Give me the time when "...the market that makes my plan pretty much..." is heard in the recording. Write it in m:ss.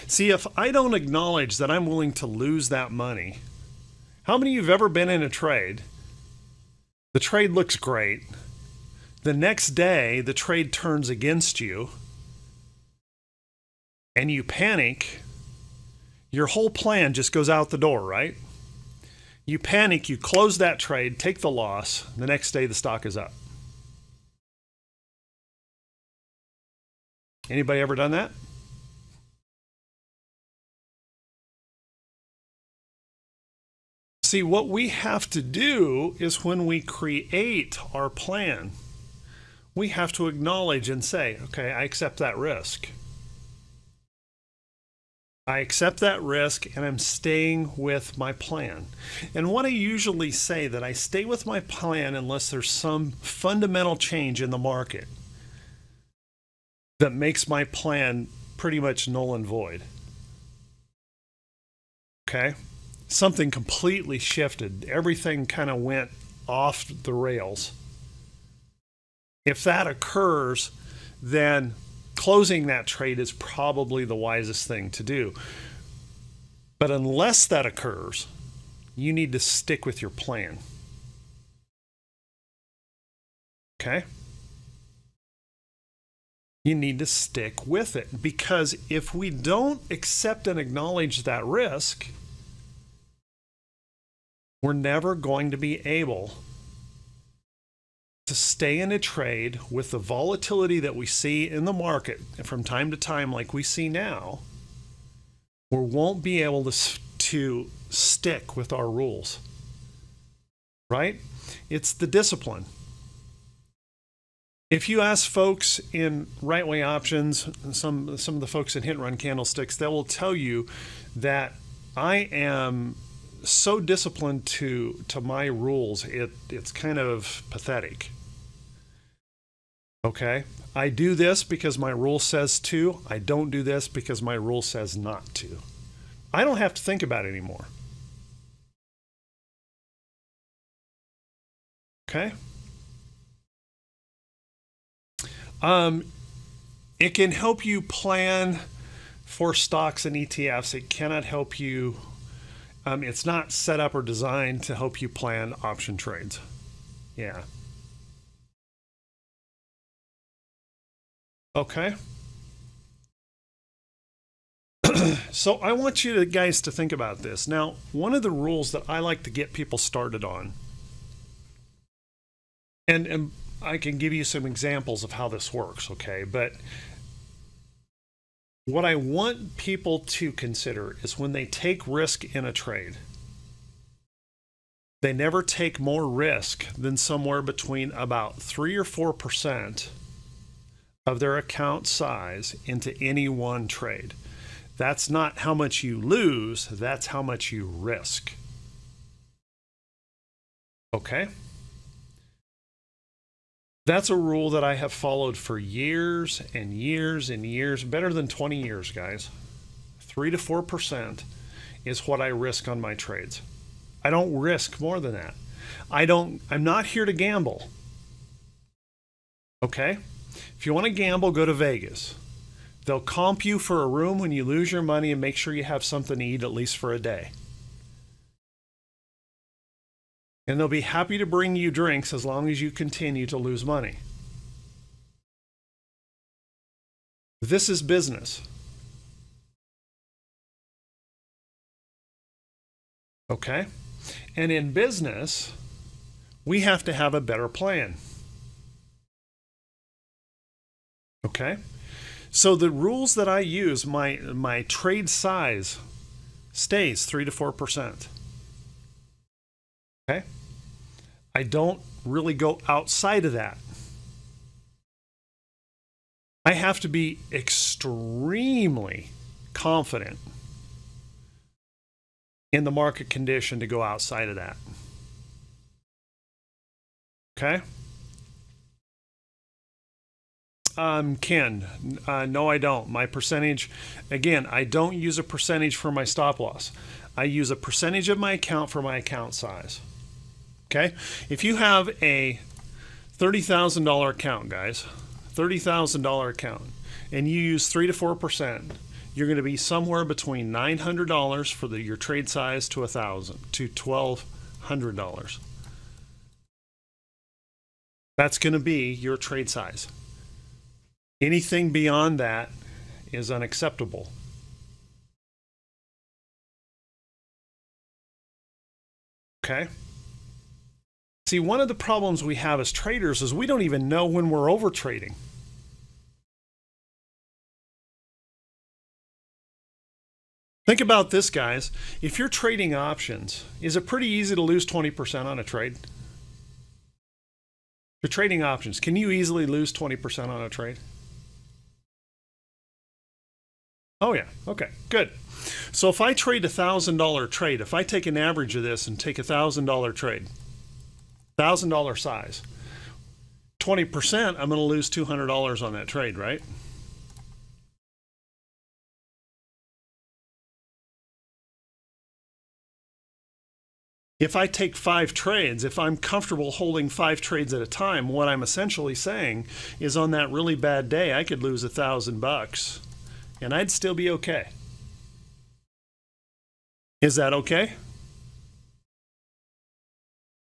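0:54.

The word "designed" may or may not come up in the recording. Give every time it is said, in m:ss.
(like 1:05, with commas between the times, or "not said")
2:34.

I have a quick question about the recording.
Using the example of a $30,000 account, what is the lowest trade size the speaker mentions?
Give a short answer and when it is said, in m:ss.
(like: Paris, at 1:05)
$900, at 5:00.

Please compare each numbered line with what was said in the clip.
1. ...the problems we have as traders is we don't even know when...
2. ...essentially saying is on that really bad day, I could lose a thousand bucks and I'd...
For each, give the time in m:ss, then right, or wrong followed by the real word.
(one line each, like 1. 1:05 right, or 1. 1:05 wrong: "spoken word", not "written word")
1. 5:21 right
2. 6:08 right.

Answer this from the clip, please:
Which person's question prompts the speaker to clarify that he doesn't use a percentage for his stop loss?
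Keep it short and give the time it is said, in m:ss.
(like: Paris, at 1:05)
Ken, at 4:41.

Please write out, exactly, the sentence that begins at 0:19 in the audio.
You panic, you close that trade, take the loss.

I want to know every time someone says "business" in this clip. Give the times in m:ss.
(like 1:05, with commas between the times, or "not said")
3:57, 4:04.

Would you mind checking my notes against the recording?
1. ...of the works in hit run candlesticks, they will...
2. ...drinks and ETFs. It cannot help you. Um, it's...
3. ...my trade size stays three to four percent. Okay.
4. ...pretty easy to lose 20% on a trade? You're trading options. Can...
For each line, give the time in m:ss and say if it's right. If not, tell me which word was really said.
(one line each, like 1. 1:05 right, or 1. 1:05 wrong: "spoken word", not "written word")
1. 1:58 wrong: "folks", not "works"
2. 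2:29 wrong: "stocks", not "drinks"
3. 4:14 right
4. 5:33 right.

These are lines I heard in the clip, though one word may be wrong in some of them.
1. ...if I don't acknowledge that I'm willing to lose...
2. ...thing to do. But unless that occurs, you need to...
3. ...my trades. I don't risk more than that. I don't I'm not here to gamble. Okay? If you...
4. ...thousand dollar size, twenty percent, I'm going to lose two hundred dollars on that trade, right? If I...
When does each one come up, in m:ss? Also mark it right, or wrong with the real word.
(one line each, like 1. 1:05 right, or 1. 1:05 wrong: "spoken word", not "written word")
1. 0:00 right
2. 1:14 right
3. 3:32 right
4. 5:51 right.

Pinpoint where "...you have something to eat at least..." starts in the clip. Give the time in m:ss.
3:45.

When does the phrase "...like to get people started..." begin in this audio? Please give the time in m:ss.
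2:48.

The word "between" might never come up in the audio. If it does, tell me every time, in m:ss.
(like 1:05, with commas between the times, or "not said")
3:07, 5:00.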